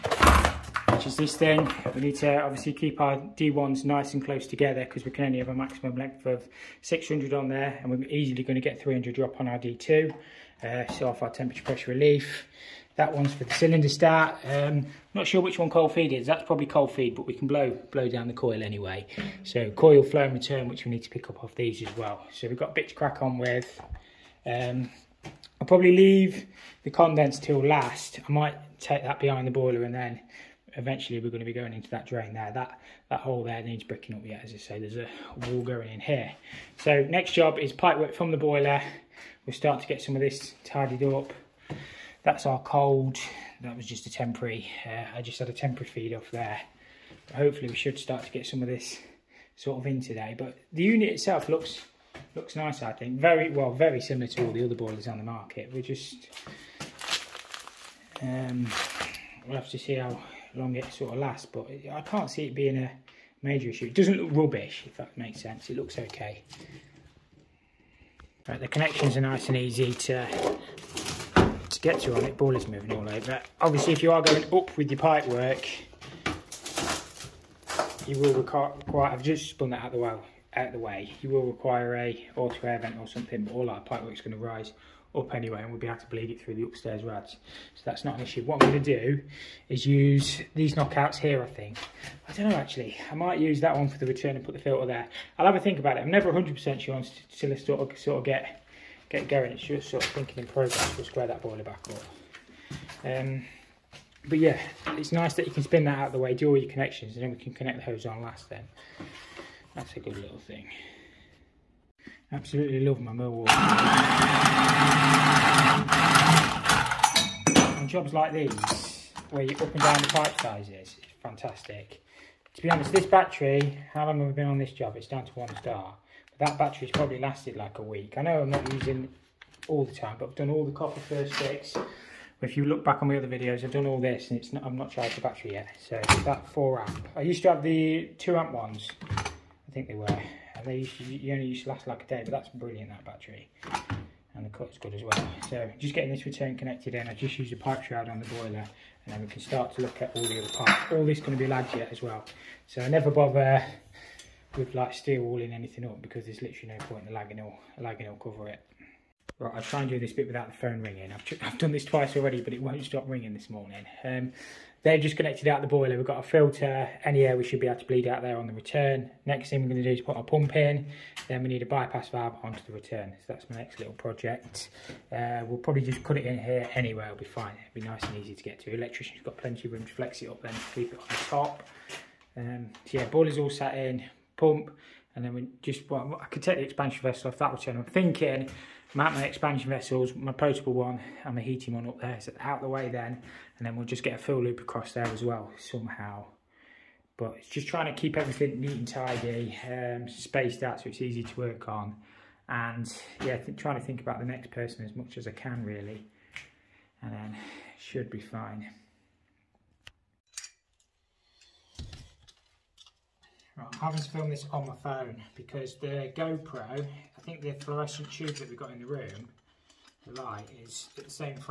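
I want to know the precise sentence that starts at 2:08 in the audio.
I know I'm not using all the time, but I've done all the copper first sticks.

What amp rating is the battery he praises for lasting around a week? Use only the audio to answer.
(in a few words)
4 amp.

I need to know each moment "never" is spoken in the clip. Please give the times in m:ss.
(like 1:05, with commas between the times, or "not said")
1:36, 2:32.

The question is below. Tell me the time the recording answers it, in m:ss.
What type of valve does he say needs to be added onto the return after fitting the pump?
2:51.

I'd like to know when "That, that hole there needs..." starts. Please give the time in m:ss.
0:32.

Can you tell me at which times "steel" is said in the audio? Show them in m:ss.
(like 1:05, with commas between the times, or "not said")
2:34.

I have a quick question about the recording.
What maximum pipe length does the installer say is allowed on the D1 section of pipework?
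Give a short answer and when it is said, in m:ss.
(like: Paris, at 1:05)
600, at 0:06.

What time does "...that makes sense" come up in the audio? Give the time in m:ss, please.
1:04.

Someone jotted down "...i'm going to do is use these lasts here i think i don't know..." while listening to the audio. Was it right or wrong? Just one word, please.
wrong.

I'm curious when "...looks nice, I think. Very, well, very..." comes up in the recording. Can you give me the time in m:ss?
0:52.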